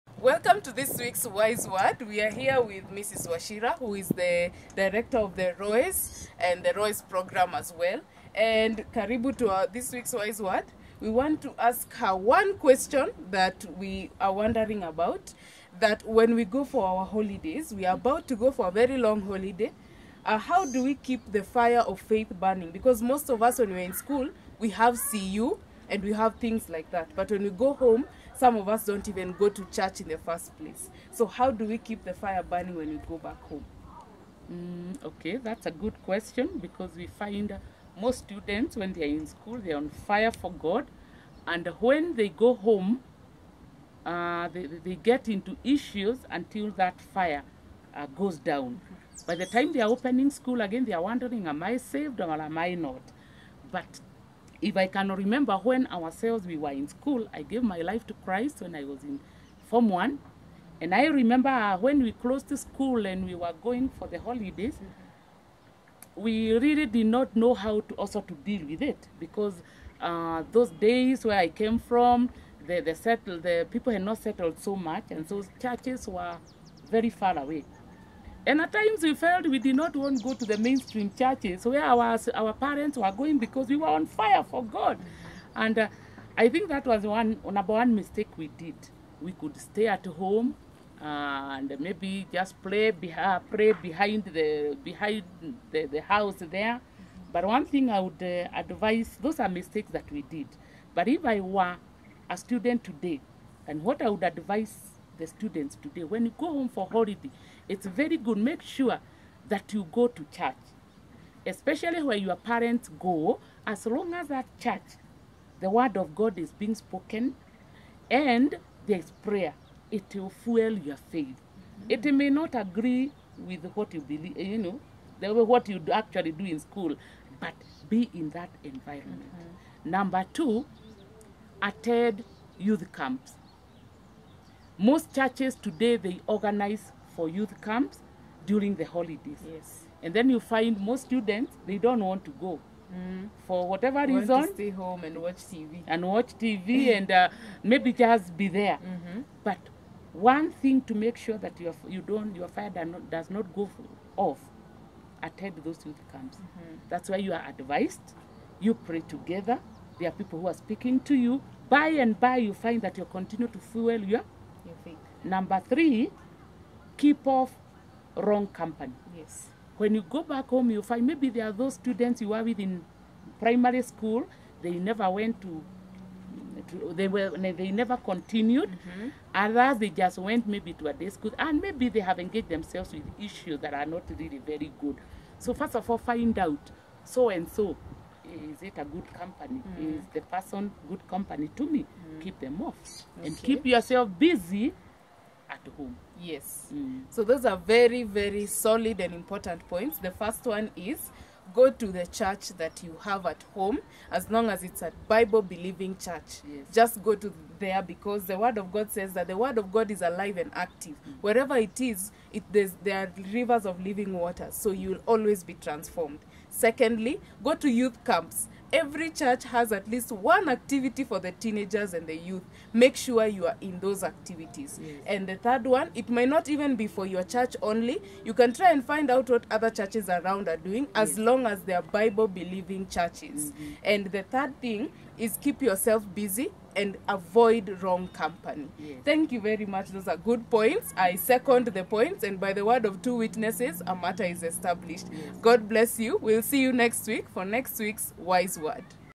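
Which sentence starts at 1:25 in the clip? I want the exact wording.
And uh, I think that was one number one mistake we did.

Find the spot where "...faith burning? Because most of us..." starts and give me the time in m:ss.
0:21.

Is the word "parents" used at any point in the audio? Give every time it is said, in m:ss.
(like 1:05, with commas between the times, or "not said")
1:22, 1:52.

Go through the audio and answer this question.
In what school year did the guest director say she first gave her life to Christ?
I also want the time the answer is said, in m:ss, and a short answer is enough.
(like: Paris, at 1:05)
Form 1, at 0:59.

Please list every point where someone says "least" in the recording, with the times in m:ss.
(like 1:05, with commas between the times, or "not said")
3:39.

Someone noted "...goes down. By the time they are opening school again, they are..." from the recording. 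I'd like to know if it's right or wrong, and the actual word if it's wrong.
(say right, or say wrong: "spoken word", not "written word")
right.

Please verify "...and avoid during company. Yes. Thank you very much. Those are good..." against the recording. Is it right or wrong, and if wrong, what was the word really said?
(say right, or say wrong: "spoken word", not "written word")
wrong: "wrong", not "during".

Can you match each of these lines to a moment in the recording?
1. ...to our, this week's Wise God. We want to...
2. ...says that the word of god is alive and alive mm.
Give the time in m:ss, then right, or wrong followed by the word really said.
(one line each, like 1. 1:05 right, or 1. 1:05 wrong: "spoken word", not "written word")
1. 0:09 wrong: "Word", not "God"
2. 3:28 wrong: "active", not "alive".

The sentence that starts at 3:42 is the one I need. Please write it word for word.
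Make sure you are in those activities.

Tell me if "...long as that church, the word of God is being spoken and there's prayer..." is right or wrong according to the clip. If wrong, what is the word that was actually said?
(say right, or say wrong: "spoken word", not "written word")
right.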